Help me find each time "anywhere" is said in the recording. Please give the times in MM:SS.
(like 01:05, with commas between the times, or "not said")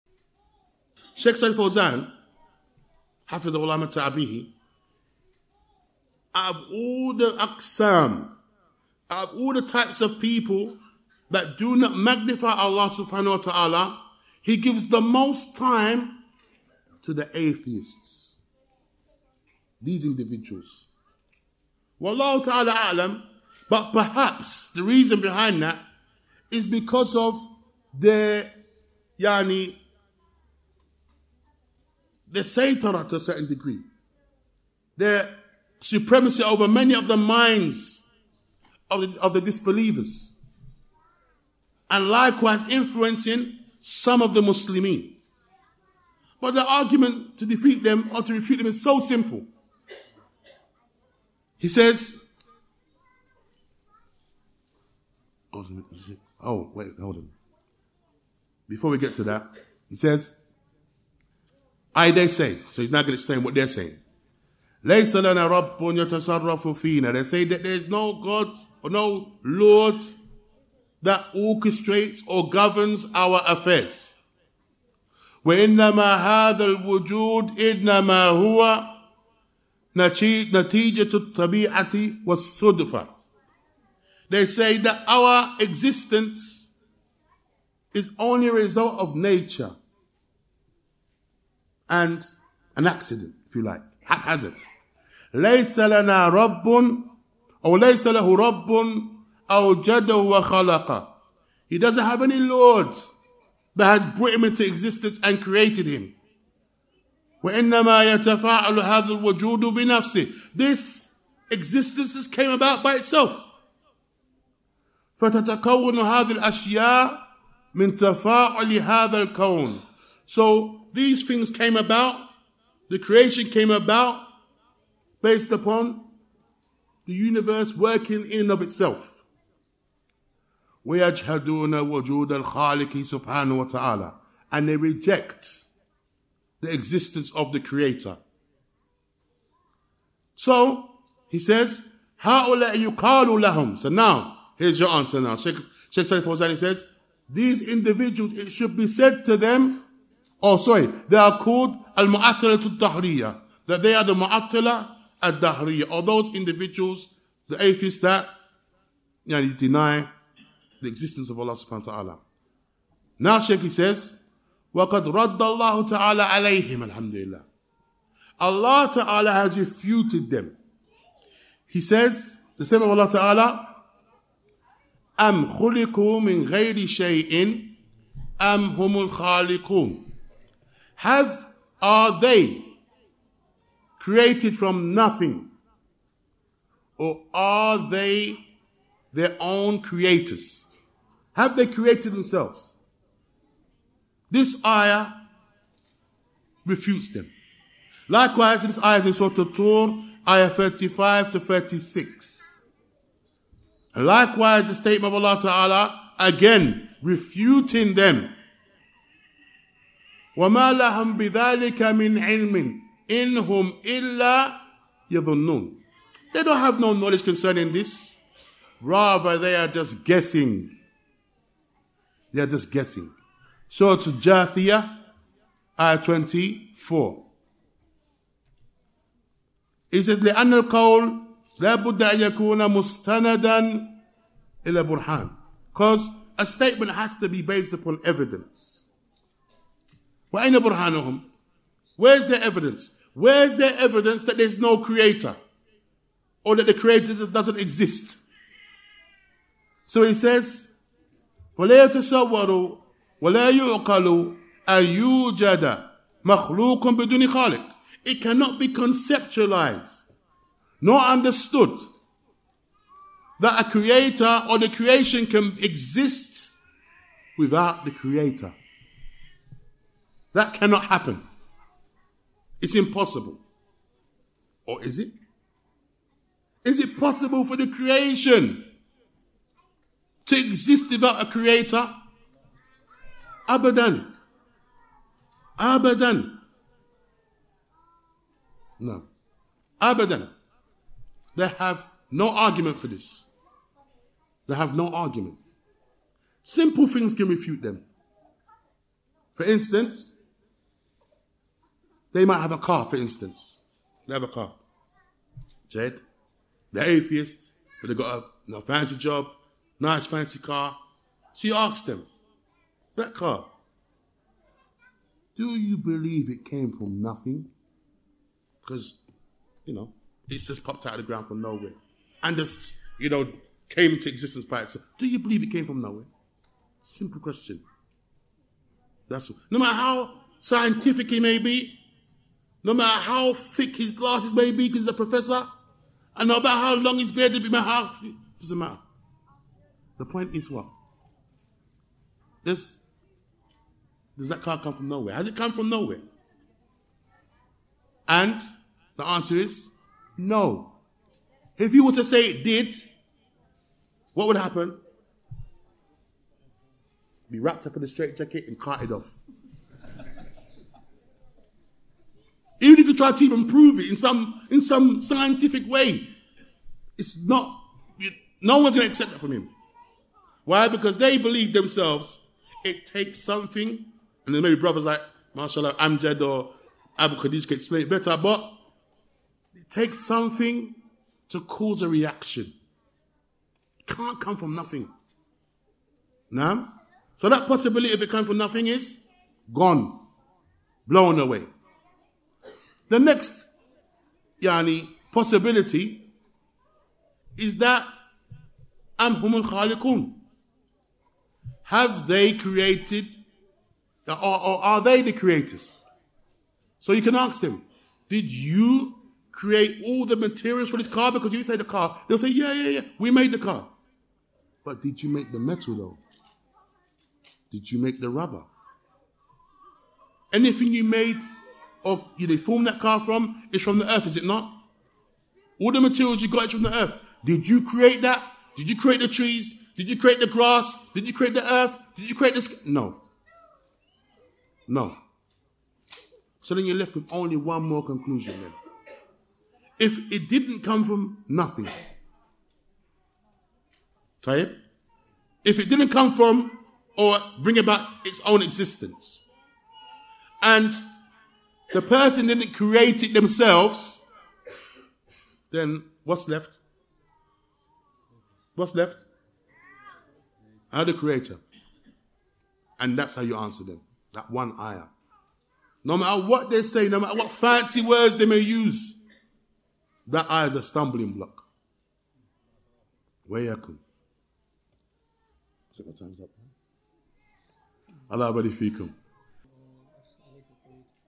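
not said.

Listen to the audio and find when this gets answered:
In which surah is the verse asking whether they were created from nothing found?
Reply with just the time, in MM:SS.
03:19.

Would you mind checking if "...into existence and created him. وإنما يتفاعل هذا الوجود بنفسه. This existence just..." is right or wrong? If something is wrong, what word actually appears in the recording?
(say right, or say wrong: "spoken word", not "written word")
right.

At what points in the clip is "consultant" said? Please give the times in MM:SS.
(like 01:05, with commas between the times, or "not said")
not said.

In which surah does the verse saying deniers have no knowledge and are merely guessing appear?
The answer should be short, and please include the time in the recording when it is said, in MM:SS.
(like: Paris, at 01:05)
Jathia, at 03:44.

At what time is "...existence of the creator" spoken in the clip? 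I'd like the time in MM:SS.
02:16.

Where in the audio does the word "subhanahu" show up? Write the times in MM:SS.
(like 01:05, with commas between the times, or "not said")
00:12, 02:41.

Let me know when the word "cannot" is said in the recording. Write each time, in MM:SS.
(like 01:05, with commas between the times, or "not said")
04:18, 04:30.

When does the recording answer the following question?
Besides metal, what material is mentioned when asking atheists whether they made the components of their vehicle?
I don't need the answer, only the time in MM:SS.
06:58.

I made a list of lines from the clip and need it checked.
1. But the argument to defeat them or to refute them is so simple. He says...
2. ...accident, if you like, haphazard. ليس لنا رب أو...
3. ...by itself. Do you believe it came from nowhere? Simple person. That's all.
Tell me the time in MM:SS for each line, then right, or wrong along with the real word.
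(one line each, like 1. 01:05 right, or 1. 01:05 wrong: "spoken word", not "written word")
1. 00:46 right
2. 01:32 right
3. 05:24 wrong: "question", not "person".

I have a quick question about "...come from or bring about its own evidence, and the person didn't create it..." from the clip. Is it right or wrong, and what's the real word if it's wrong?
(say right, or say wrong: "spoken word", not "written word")
wrong: "existence", not "evidence".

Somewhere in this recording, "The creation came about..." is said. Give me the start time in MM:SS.
02:02.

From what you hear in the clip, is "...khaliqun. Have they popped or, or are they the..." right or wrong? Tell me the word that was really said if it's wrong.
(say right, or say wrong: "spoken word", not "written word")
wrong: "created", not "popped".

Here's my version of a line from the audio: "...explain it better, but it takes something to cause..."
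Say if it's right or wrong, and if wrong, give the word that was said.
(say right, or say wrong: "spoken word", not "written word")
right.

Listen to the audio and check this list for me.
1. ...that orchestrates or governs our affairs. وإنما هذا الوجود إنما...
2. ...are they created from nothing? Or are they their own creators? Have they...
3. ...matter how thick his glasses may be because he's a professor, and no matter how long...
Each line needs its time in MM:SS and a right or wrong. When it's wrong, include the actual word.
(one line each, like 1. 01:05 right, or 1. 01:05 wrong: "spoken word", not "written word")
1. 01:11 right
2. 03:01 right
3. 05:32 right.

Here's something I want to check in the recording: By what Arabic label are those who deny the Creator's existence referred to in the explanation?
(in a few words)
al muattila dahriya.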